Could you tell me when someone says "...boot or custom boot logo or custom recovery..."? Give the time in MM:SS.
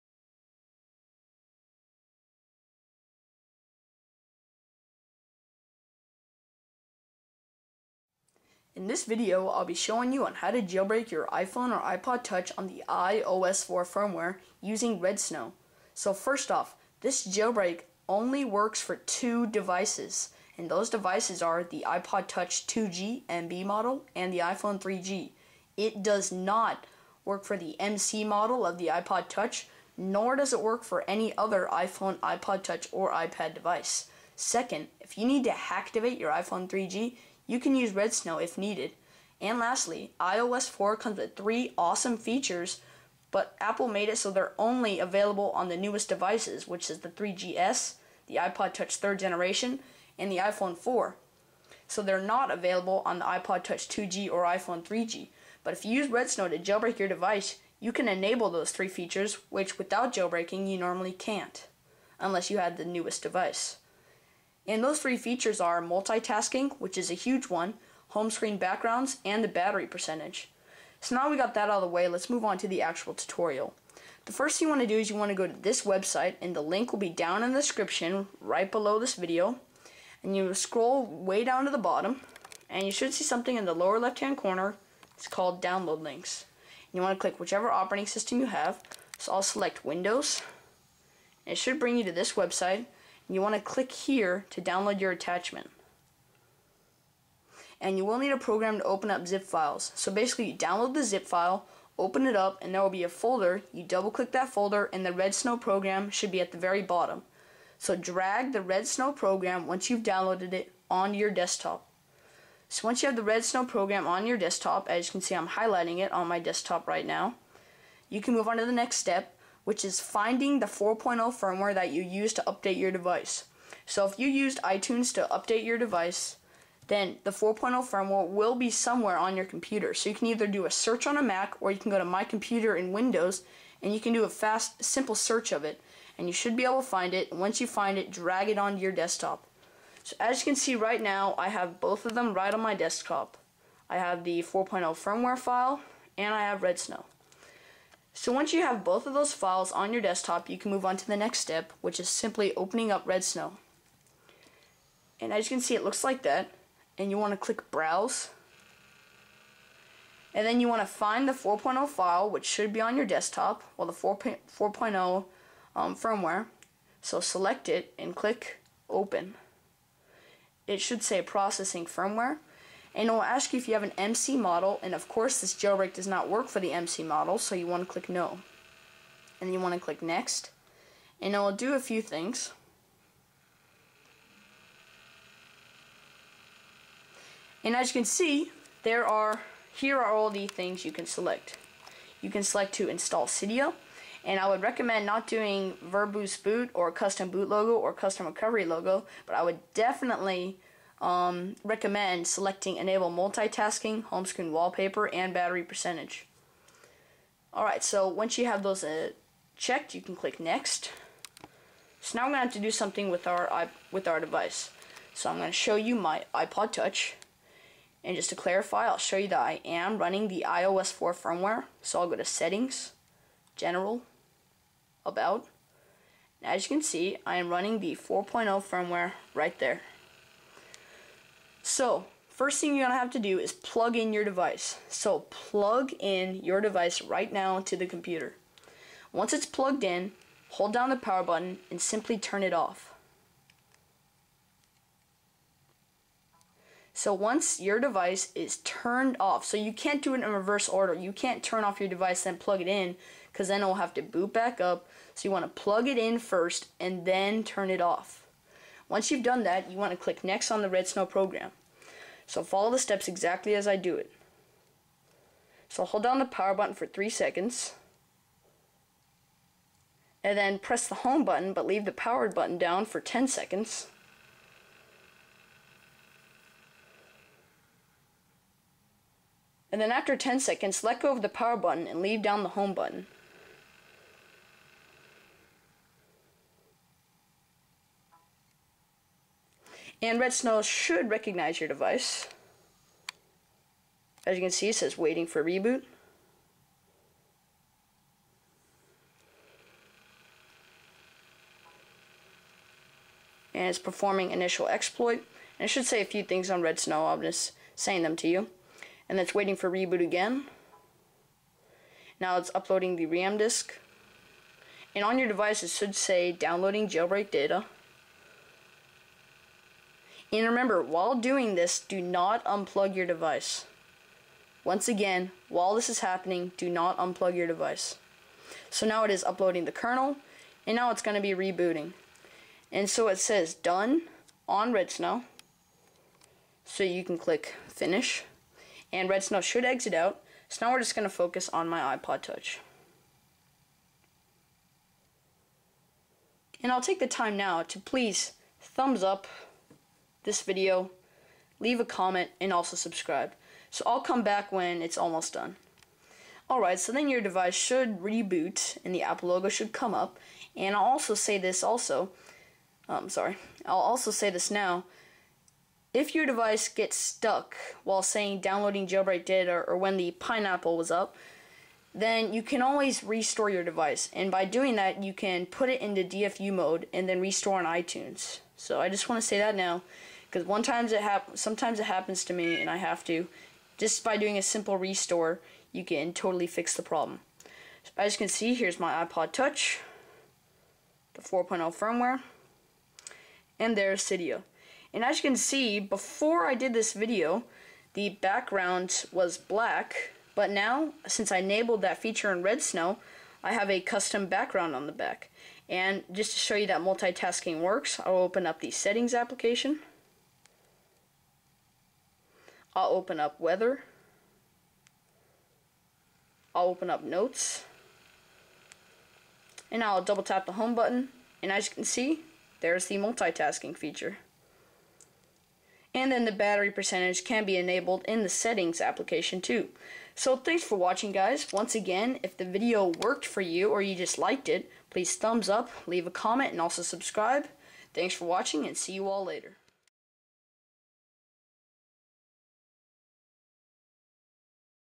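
03:16.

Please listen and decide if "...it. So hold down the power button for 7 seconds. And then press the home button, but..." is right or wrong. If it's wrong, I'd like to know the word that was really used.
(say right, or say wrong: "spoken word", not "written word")
wrong: "3", not "7".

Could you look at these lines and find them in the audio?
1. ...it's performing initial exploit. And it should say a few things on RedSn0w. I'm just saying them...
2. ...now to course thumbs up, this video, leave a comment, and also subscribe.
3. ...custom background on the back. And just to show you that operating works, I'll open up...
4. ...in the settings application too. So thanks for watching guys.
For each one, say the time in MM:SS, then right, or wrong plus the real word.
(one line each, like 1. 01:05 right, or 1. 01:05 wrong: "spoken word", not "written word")
1. 05:03 right
2. 05:47 wrong: "please", not "course"
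3. 06:43 wrong: "multitasking", not "operating"
4. 07:08 right.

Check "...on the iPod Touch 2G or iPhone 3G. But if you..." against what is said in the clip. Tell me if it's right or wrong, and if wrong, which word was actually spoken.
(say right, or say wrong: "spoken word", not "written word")
right.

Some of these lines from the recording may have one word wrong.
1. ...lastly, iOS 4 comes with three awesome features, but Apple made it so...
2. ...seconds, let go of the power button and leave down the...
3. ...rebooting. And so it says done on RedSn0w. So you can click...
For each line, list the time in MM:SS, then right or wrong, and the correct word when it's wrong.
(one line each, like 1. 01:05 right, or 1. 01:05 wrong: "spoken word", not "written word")
1. 00:39 right
2. 04:40 right
3. 05:31 right.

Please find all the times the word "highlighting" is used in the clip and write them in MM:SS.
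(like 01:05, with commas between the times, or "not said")
01:55.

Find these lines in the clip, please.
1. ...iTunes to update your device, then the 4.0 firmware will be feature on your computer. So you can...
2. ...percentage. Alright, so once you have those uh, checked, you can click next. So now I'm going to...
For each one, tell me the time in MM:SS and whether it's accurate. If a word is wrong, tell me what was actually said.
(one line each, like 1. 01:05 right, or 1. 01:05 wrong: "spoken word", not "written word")
1. 02:04 wrong: "somewhere", not "feature"
2. 03:25 right.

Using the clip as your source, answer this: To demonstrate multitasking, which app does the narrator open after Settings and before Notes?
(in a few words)
Weather.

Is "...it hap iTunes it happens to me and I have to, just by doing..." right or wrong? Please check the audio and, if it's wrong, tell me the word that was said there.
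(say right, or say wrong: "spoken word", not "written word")
wrong: "sometimes", not "iTunes".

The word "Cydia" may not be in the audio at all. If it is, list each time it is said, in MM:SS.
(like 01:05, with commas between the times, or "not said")
03:13, 06:34.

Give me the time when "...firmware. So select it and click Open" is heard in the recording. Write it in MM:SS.
02:45.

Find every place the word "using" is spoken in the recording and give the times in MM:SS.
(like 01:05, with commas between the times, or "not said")
00:14.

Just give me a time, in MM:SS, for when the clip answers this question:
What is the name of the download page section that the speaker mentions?
01:25.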